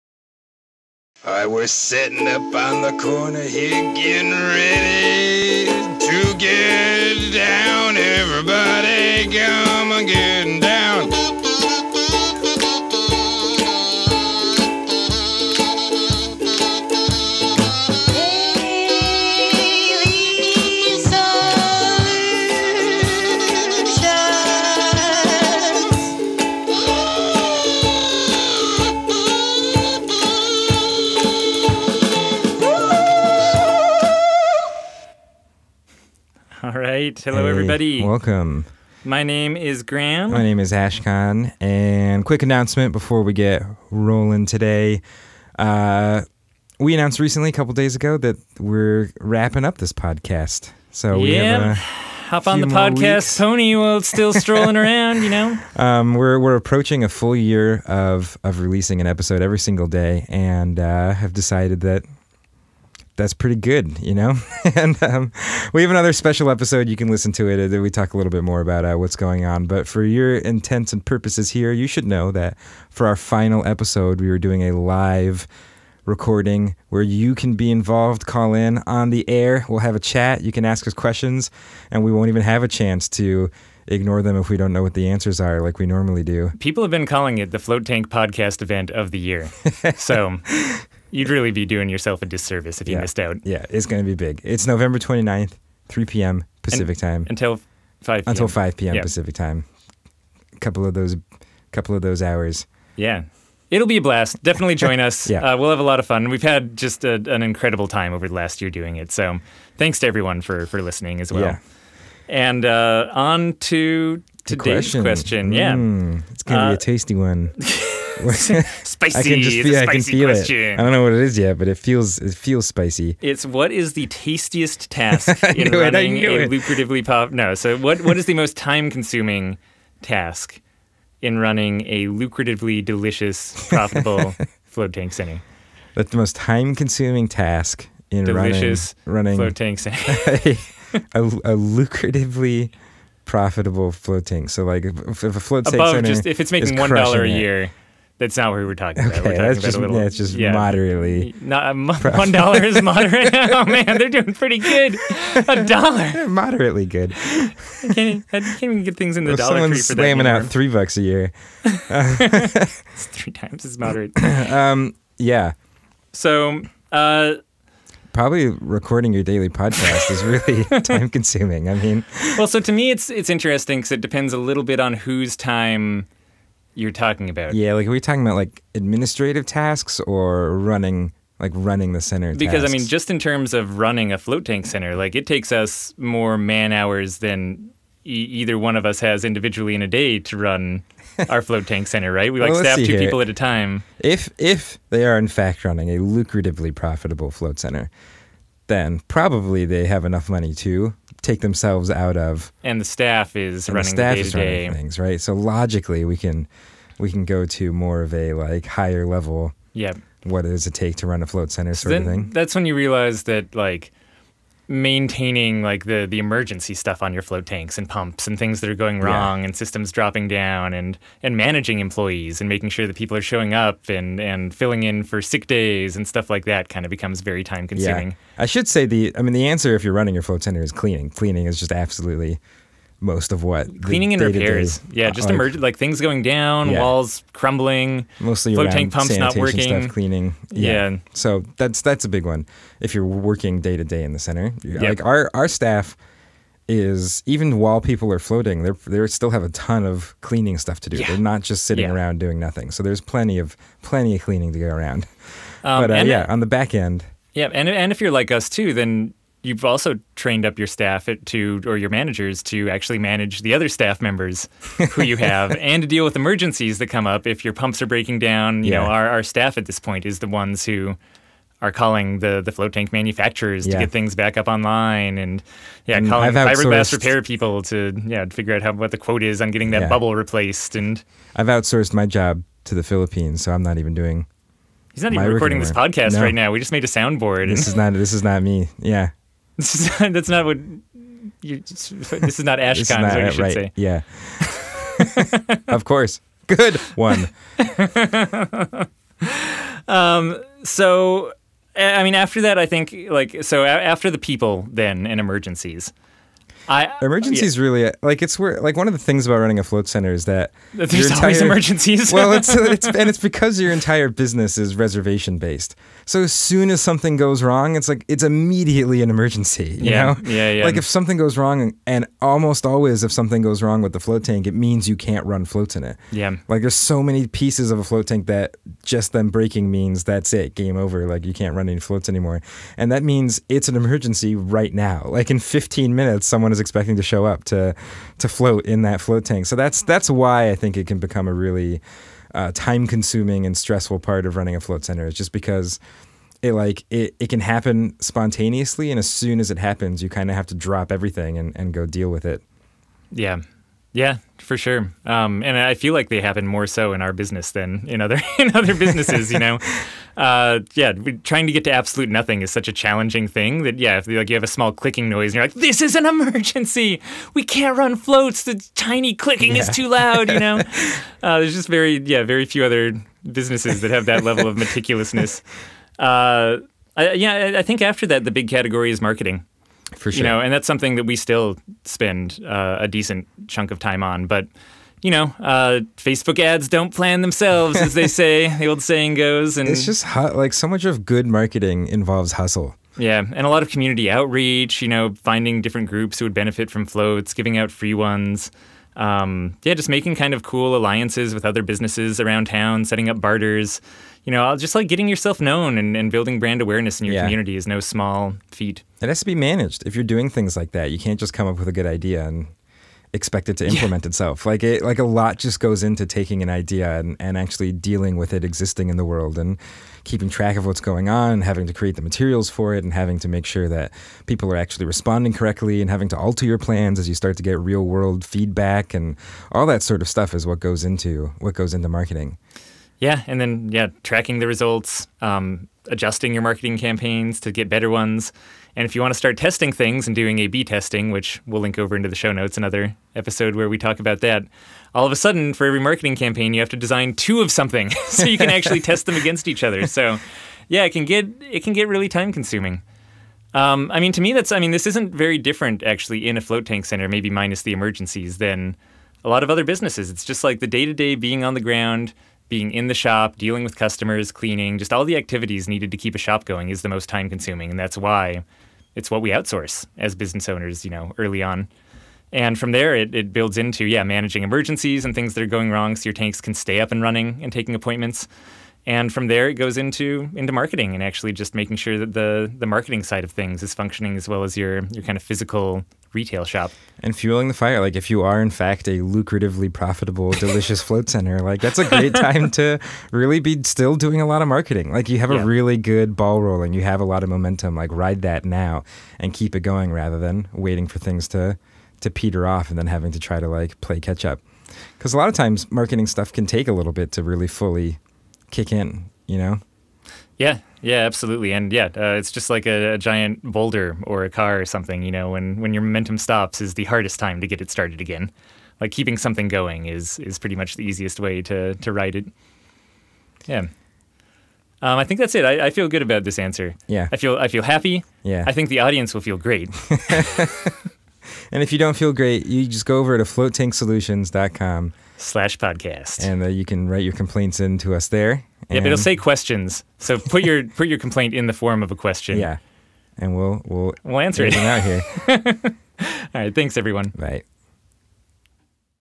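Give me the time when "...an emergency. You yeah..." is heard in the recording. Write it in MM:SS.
05:19.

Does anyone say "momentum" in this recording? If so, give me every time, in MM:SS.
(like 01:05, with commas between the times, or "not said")
08:17, 08:35.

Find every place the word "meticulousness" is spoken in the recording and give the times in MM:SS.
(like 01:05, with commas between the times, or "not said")
06:14.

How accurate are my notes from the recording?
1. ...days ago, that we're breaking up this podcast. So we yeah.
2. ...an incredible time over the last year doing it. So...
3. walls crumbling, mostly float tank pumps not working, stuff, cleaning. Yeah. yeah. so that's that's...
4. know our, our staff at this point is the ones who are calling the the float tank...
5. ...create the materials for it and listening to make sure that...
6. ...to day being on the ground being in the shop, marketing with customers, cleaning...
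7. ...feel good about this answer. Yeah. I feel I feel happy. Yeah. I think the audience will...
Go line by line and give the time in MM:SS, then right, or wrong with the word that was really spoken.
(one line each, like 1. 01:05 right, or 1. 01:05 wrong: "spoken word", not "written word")
1. 00:47 wrong: "wrapping", not "breaking"
2. 01:47 right
3. 03:56 right
4. 04:28 right
5. 07:01 wrong: "having", not "listening"
6. 07:40 wrong: "dealing", not "marketing"
7. 08:45 right.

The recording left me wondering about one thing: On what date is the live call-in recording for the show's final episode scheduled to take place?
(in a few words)
November 29th.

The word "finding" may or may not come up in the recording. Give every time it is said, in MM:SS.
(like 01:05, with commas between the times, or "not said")
06:35.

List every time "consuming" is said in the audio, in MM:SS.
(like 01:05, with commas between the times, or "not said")
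02:08, 02:16, 02:51, 03:47, 05:42, 07:32, 07:47.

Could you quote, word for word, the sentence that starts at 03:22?
And the staff is and running the staff the is running things, right?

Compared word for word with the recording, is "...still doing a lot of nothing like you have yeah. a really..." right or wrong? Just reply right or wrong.
wrong.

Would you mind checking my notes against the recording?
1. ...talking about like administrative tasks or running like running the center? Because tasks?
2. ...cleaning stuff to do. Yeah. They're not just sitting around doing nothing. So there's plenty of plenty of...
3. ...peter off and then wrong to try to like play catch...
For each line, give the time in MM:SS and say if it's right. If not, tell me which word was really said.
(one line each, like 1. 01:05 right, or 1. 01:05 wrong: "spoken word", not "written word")
1. 02:57 right
2. 04:10 right
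3. 08:22 wrong: "having", not "wrong".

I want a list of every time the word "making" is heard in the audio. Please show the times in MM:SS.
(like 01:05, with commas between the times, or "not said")
02:26, 03:42, 06:39, 08:01.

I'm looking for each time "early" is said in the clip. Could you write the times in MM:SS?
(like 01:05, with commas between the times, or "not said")
07:51.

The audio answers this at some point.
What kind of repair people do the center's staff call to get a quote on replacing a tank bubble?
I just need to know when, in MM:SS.
04:36.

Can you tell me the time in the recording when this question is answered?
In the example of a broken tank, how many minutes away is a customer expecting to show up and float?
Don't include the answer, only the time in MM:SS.
05:35.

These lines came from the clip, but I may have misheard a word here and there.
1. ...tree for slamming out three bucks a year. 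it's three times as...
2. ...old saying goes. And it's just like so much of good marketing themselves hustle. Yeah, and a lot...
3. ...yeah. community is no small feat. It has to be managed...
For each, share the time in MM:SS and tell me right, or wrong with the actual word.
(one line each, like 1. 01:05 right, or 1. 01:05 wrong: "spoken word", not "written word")
1. 02:39 right
2. 06:28 wrong: "involves", not "themselves"
3. 06:47 right.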